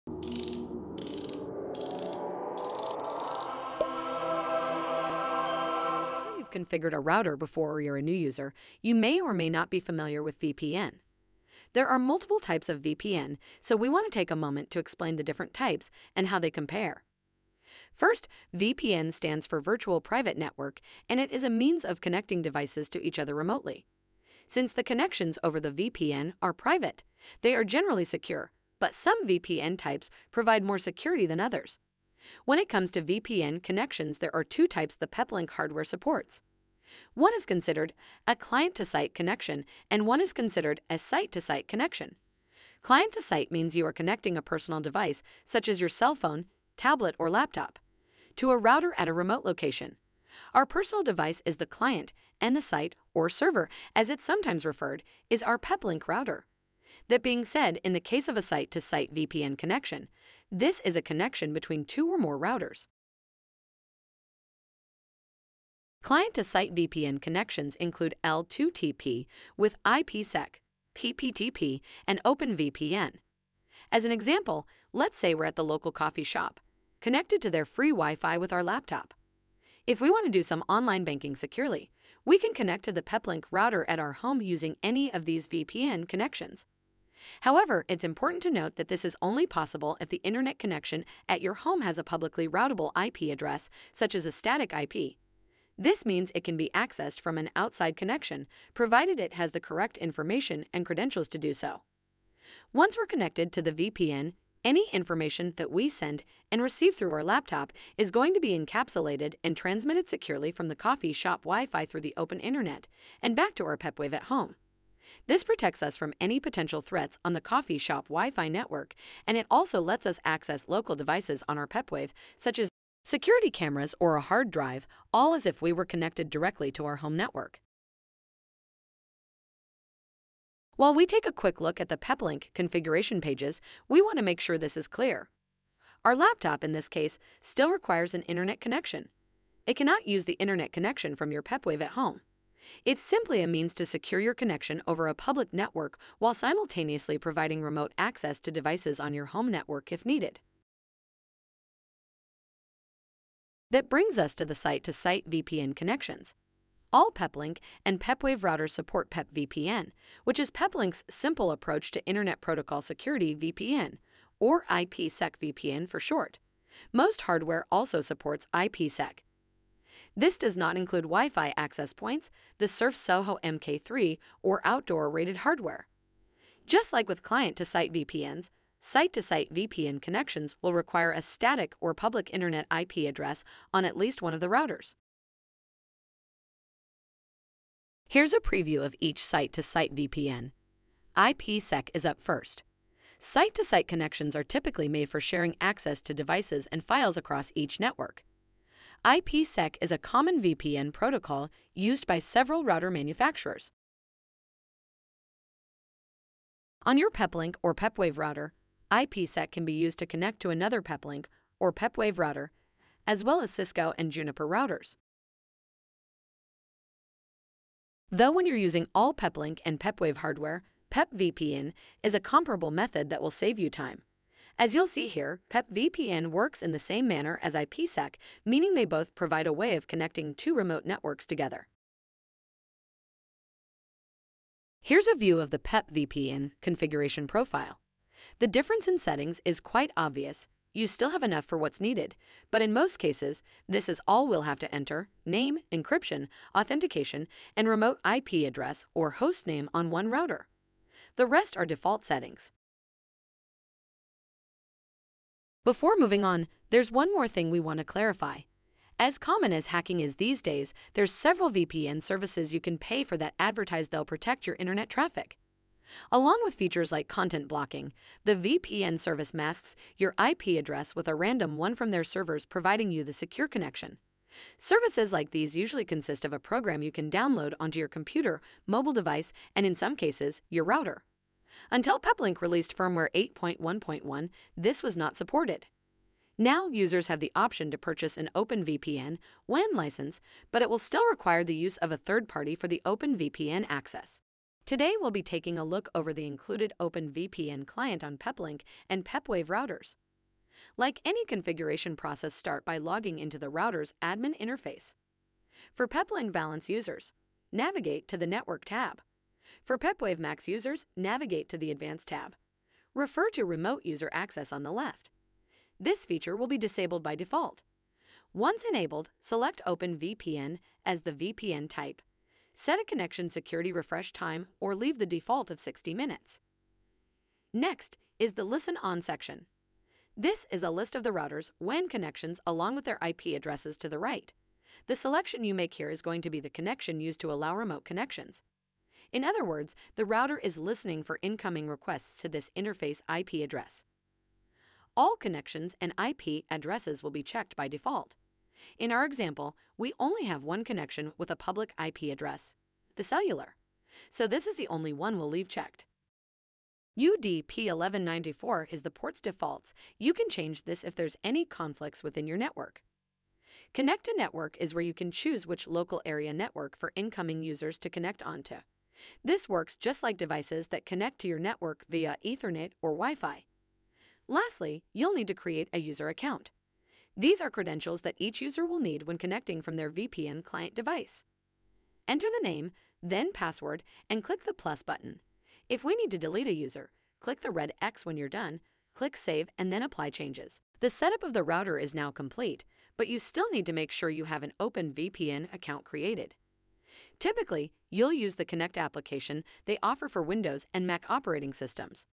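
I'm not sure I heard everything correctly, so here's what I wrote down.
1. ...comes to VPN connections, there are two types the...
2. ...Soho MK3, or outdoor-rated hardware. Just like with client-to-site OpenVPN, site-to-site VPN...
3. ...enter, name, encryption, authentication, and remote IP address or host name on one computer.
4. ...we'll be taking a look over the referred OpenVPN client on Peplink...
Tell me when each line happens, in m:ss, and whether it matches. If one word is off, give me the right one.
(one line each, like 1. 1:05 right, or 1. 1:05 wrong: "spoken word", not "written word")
1. 0:32 right
2. 2:52 wrong: "VPNs", not "OpenVPN"
3. 4:04 wrong: "router", not "computer"
4. 4:54 wrong: "included", not "referred".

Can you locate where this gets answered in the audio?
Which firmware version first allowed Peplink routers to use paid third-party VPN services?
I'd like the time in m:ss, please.
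4:43.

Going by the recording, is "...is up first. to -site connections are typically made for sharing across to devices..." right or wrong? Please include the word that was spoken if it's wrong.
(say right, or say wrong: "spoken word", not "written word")
wrong: "access", not "across".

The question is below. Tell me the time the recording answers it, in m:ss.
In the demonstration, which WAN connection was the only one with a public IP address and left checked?
5:52.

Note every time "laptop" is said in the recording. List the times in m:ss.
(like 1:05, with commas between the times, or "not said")
0:47, 1:18, 1:47, 2:16.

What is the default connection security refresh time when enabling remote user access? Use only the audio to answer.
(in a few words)
60 minutes.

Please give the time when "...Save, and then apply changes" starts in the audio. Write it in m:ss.
6:29.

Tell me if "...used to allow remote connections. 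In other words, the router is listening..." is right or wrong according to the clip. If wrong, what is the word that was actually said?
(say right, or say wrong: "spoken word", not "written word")
right.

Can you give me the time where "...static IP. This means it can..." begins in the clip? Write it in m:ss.
1:34.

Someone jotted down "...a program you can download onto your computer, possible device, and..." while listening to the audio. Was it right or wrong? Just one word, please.
wrong.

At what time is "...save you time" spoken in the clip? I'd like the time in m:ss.
3:43.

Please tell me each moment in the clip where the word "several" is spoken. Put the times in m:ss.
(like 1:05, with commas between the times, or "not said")
3:22, 4:21.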